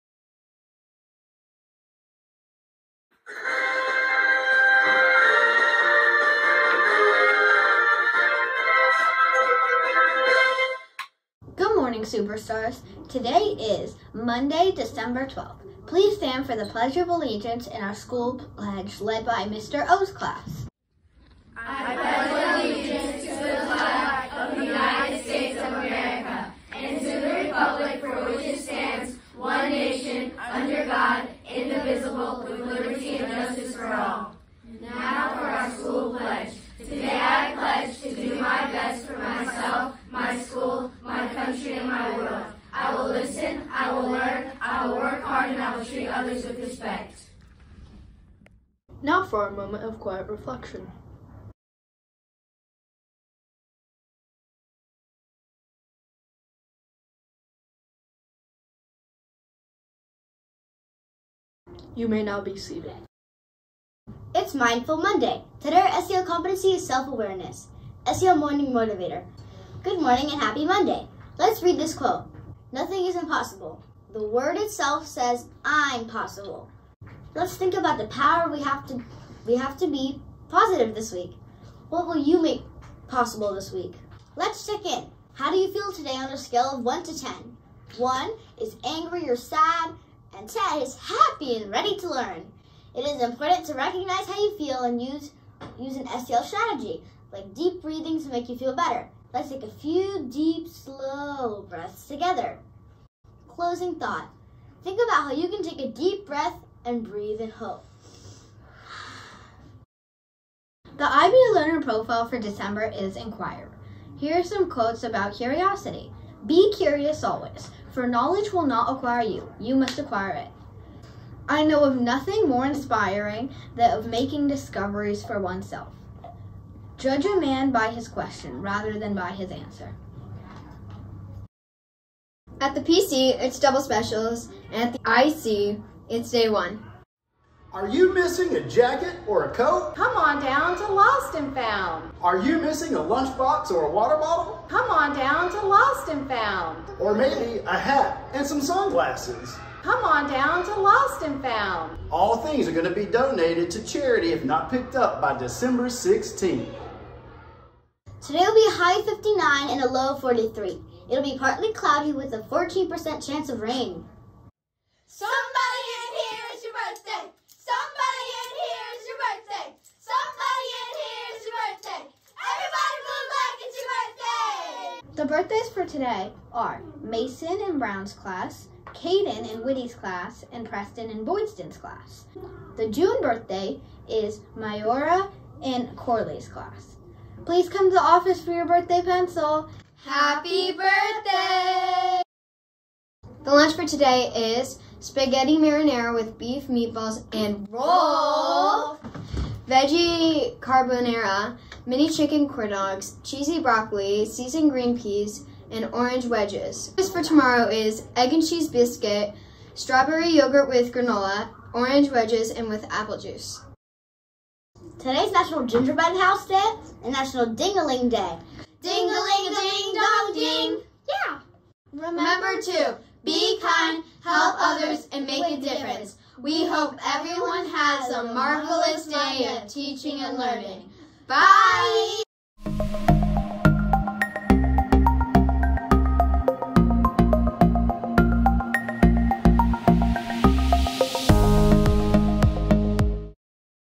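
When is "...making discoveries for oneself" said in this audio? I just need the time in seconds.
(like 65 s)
124 s.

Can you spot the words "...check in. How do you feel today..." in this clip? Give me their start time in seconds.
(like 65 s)
84 s.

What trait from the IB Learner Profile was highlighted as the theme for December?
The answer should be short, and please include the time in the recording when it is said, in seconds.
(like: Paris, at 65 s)
Inquirer, at 113 s.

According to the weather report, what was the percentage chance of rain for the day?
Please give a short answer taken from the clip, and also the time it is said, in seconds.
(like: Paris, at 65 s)
14%, at 162 s.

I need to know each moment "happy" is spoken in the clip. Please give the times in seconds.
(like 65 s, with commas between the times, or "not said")
70 s, 90 s, 190 s.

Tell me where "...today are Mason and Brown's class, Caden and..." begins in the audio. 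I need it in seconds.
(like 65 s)
175 s.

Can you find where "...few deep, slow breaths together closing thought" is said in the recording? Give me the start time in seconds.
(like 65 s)
99 s.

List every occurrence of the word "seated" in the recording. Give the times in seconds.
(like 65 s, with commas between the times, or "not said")
62 s.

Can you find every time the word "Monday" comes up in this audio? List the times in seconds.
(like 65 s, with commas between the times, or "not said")
14 s, 64 s, 70 s.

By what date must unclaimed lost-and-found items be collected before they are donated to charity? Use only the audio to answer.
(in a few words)
December 16th.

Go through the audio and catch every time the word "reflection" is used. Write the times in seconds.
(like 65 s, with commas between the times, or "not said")
50 s.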